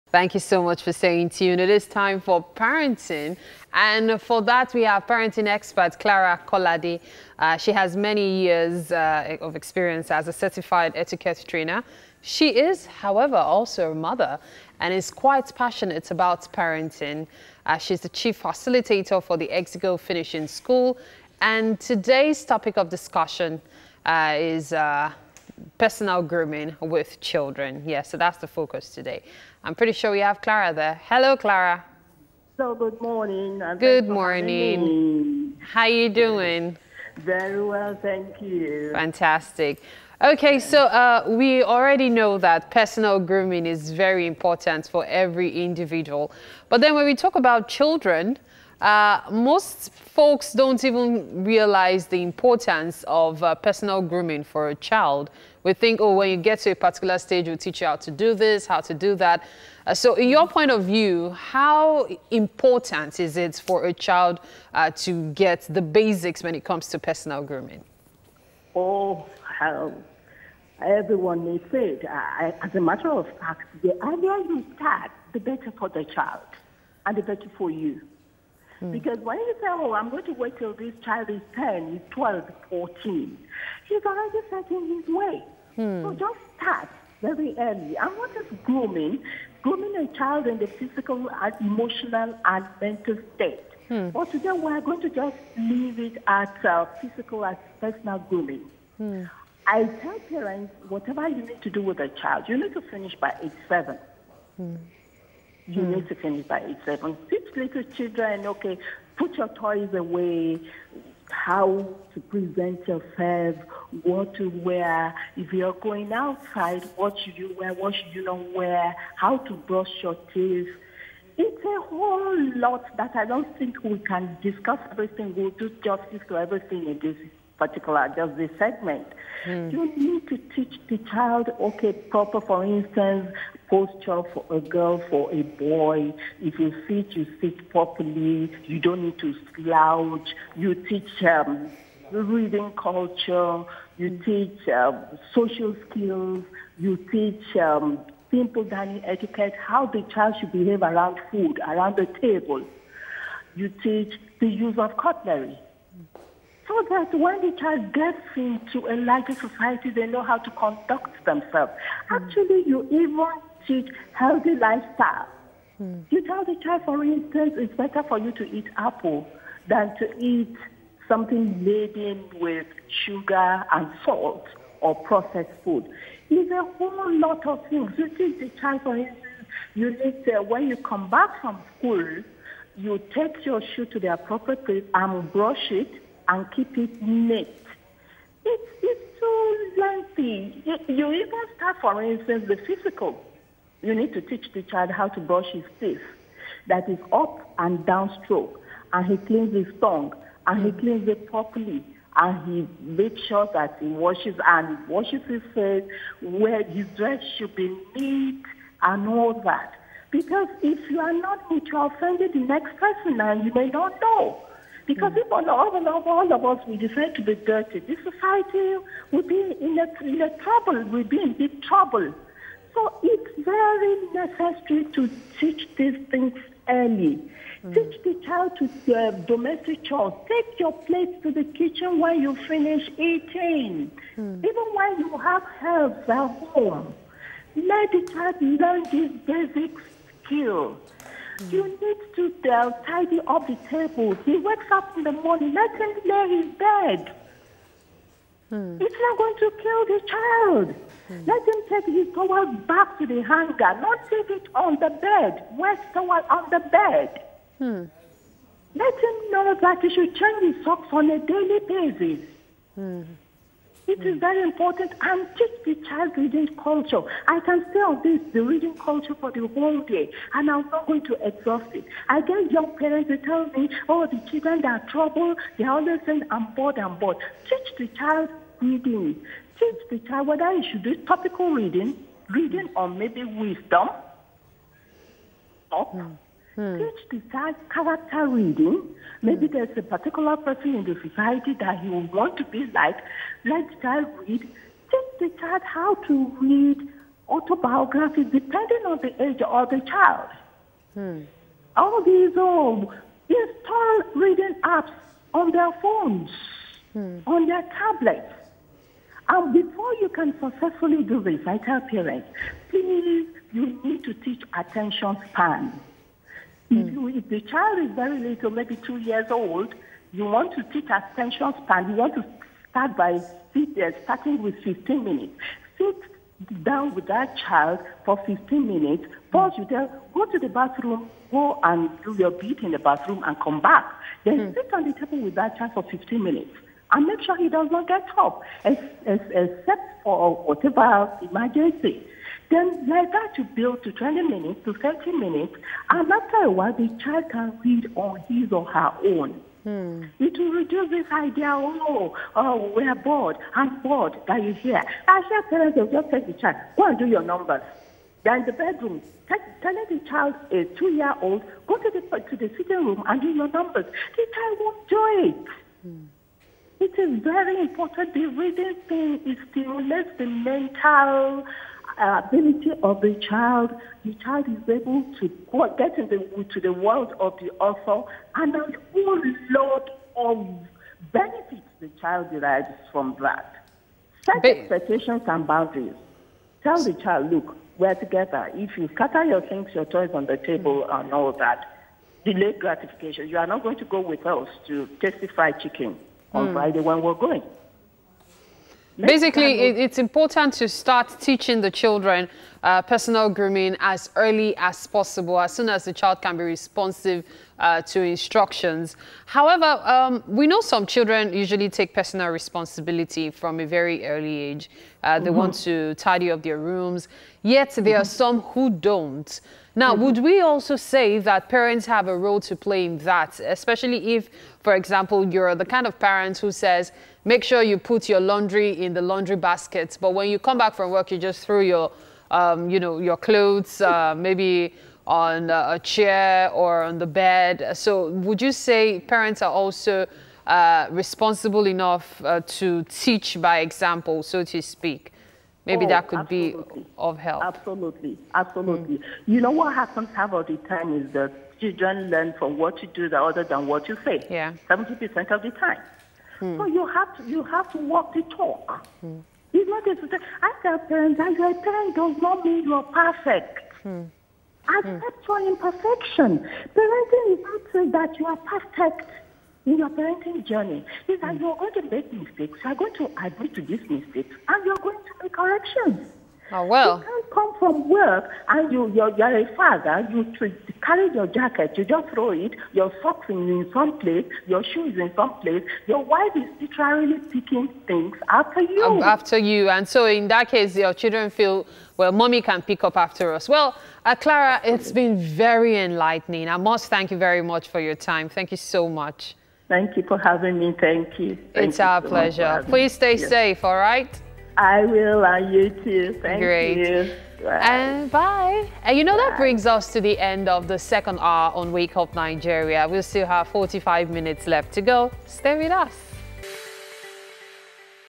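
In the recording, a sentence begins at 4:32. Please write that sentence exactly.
I get young parents, who tell me, oh, the children, are trouble.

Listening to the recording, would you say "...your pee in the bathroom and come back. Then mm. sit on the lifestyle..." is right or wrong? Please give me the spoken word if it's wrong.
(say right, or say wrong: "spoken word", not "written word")
wrong: "table", not "lifestyle".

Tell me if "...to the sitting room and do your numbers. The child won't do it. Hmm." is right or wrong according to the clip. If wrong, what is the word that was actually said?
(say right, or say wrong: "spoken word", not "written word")
right.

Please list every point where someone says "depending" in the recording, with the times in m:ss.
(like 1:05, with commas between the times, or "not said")
4:58.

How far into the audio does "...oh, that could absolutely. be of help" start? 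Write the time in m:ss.
7:25.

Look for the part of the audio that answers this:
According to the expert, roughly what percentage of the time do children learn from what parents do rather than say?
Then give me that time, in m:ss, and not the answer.
7:34.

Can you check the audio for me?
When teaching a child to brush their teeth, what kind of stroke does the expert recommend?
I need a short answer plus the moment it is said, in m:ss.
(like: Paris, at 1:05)
up and down, at 3:17.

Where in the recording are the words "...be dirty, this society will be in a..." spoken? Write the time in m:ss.
3:37.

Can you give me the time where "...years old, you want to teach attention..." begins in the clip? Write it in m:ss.
5:18.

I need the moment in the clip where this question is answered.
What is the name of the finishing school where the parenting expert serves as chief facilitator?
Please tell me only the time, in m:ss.
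0:19.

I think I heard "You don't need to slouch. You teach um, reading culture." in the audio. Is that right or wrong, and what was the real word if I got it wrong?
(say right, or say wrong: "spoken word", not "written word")
right.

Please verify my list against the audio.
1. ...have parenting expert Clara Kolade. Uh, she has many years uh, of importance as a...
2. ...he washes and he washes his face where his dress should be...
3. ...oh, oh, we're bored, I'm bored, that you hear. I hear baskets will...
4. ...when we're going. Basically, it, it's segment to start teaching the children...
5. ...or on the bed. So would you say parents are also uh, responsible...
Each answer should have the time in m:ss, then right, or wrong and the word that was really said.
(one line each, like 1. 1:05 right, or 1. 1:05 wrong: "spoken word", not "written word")
1. 0:04 wrong: "experience", not "importance"
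2. 3:23 right
3. 5:51 wrong: "parents", not "baskets"
4. 6:36 wrong: "important", not "segment"
5. 7:16 right.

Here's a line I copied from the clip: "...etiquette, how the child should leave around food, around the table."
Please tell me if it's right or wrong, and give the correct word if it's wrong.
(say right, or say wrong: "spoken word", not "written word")
wrong: "behave", not "leave".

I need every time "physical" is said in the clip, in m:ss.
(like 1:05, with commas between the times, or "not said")
1:30, 1:36, 3:12.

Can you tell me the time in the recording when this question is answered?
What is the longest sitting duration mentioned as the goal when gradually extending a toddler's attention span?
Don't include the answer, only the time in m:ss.
5:44.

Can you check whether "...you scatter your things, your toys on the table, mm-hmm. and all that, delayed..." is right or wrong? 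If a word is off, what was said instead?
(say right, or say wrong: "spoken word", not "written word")
right.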